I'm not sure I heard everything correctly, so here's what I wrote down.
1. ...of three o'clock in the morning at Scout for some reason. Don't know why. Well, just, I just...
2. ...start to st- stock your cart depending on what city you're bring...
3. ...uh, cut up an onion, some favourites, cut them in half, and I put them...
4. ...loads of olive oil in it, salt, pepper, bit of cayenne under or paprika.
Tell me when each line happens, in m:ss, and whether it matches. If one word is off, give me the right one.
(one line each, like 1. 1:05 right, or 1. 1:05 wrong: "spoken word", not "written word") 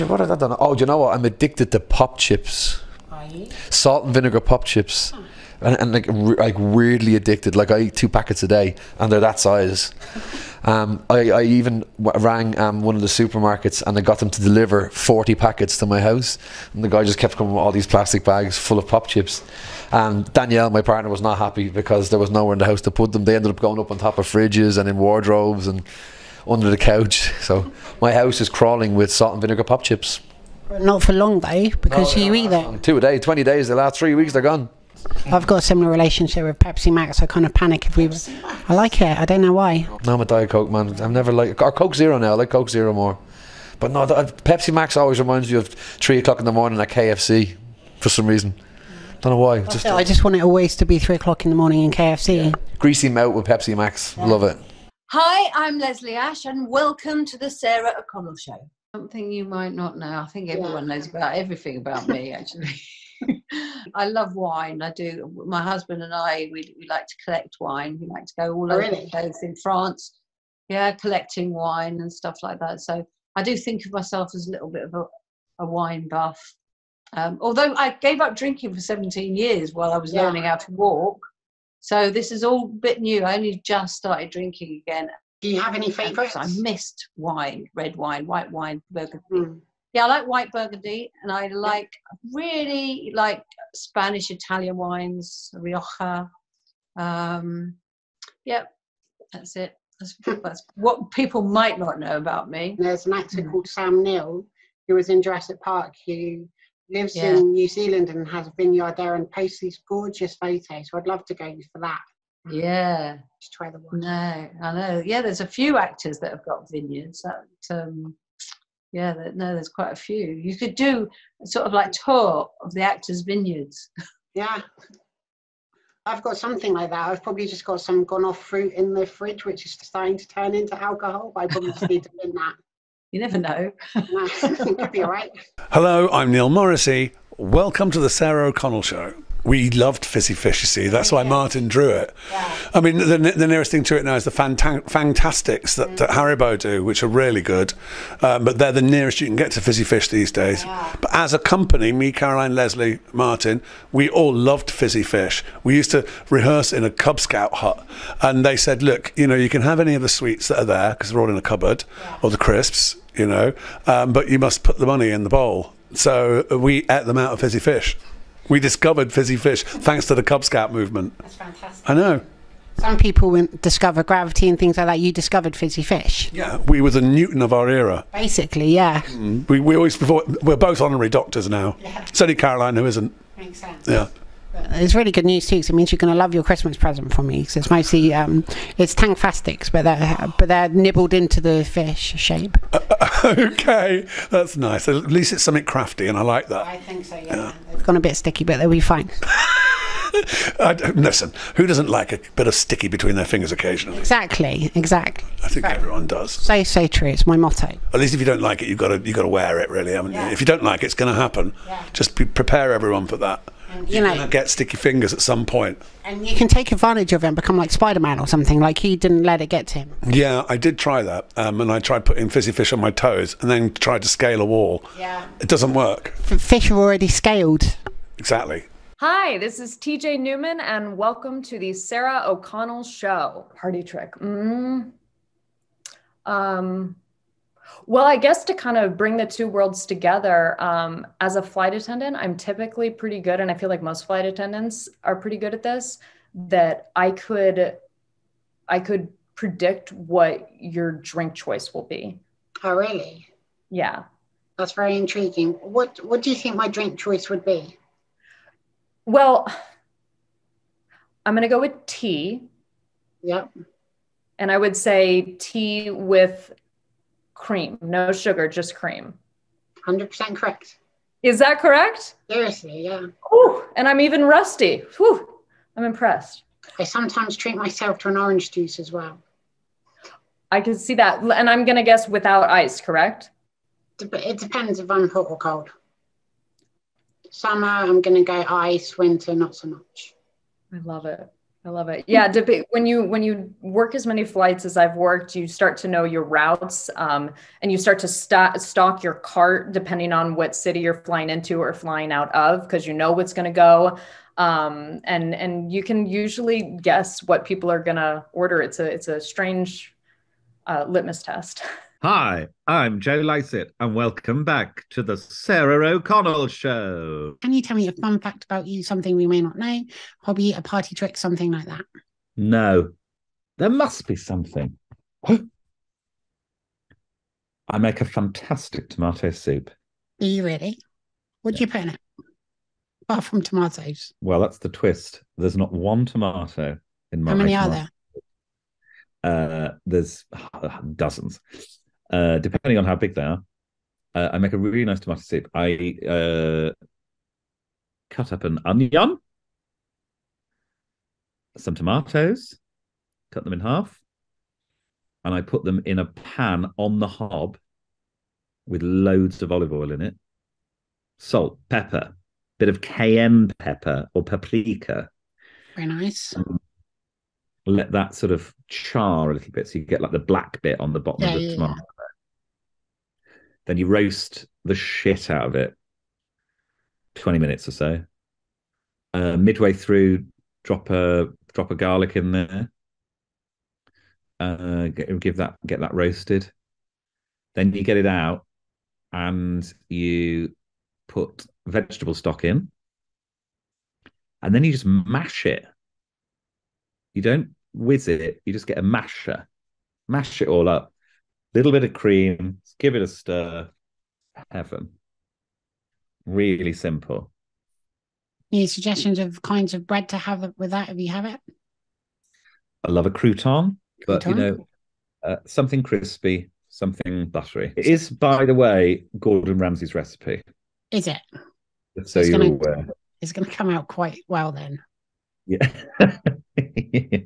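1. 0:45 wrong: "KFC", not "Scout"
2. 4:57 wrong: "flying", not "bring"
3. 5:46 wrong: "tomatoes", not "favourites"
4. 5:58 wrong: "pepper", not "under".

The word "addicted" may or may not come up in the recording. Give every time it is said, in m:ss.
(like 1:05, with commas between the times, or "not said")
0:01, 0:07.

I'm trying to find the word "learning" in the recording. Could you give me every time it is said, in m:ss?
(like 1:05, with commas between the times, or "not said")
1:20.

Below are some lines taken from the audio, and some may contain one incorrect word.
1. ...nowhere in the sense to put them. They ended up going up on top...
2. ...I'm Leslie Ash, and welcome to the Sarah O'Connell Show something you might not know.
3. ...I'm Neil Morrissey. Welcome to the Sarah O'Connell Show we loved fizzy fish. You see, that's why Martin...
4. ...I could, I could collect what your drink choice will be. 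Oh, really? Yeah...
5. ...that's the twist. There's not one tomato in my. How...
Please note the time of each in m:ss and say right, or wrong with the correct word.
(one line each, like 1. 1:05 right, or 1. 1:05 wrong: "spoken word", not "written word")
1. 0:22 wrong: "house", not "sense"
2. 0:55 right
3. 2:16 right
4. 4:06 wrong: "predict", not "collect"
5. 5:34 right.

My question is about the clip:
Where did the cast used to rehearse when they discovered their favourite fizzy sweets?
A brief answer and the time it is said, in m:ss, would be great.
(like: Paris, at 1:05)
A Cub Scout hut, at 2:36.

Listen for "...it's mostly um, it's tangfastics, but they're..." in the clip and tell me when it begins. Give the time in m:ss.
3:07.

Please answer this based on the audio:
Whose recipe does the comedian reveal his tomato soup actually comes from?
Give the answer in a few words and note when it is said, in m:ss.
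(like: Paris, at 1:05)
Gordon Ramsay, at 6:59.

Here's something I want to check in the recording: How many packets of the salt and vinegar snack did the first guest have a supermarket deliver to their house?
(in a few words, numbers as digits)
40.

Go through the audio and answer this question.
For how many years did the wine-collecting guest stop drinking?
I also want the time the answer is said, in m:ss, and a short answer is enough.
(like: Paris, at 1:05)
17, at 1:18.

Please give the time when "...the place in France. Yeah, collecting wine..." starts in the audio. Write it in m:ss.
1:08.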